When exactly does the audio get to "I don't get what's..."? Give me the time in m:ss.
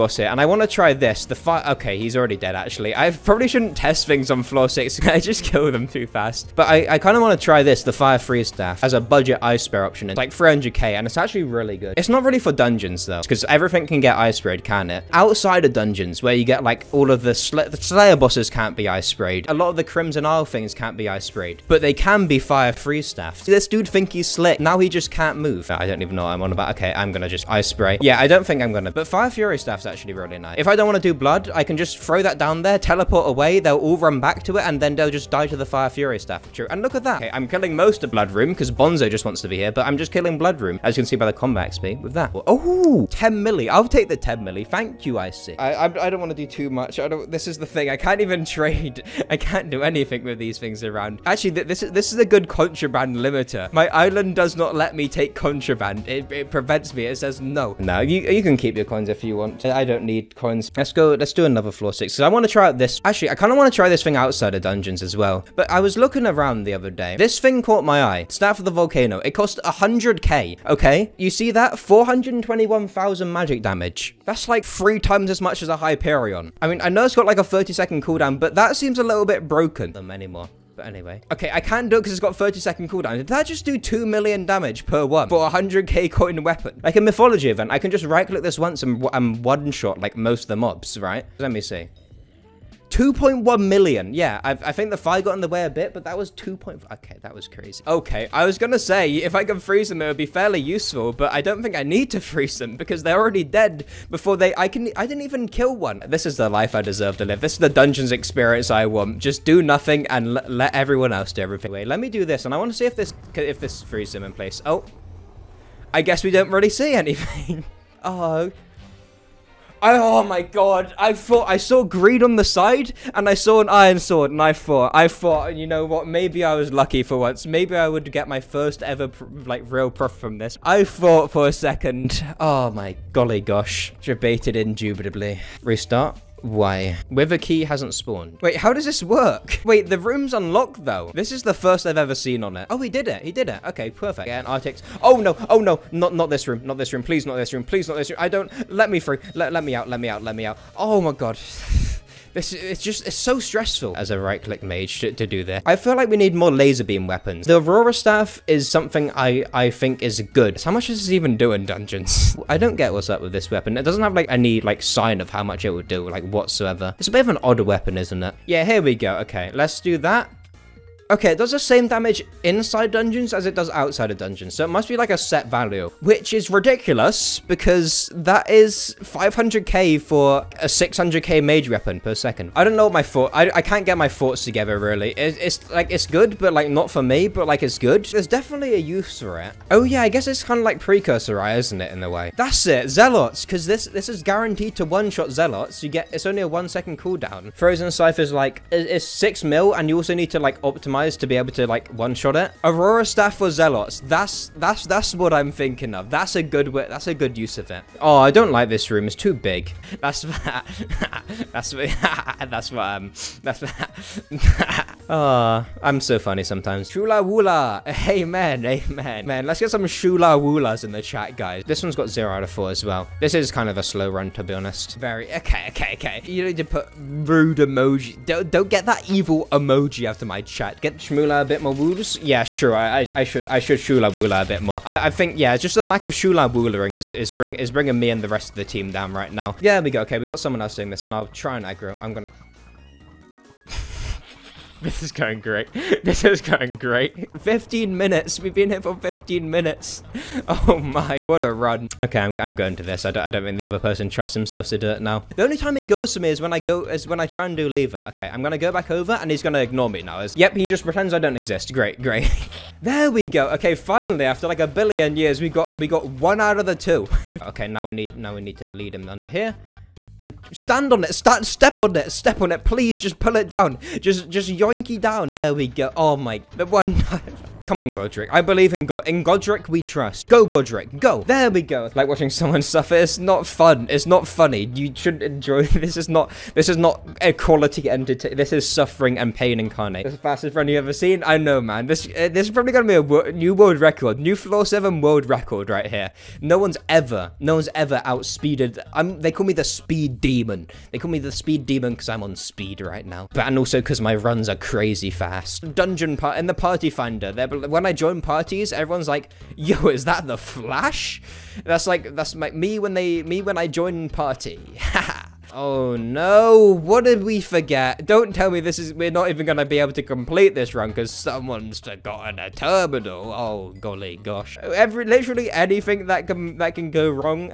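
2:42.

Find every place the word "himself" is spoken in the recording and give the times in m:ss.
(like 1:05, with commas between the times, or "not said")
4:14.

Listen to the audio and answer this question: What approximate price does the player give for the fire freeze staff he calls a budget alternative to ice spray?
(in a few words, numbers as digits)
300k.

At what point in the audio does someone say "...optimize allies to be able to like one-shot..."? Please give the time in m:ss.
3:20.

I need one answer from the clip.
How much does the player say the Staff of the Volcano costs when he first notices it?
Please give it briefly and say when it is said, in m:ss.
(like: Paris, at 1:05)
100k, at 1:09.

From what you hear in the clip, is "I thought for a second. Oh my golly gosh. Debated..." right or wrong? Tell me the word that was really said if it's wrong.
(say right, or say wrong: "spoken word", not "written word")
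right.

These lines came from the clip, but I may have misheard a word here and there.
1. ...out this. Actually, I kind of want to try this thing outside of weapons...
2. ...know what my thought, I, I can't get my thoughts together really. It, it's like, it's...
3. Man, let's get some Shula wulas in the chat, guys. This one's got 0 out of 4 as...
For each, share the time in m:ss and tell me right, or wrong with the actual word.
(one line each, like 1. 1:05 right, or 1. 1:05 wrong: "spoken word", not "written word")
1. 1:02 wrong: "dungeons", not "weapons"
2. 3:02 right
3. 3:39 right.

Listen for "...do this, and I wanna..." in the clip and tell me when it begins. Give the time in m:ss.
1:52.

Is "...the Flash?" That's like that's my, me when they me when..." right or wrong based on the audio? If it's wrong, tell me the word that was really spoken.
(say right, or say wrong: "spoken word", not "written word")
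right.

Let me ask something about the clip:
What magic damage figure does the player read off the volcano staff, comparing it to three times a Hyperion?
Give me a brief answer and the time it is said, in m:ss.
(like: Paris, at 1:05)
421,000, at 1:11.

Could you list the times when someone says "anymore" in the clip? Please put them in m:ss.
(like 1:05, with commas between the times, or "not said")
1:20.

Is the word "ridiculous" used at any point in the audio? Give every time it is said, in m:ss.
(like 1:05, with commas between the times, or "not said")
2:56.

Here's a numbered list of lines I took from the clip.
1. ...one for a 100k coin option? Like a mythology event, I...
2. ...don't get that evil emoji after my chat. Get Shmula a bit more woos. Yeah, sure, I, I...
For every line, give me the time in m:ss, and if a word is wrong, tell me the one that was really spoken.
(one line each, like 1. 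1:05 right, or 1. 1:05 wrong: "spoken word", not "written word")
1. 1:25 wrong: "weapon", not "option"
2. 3:48 right.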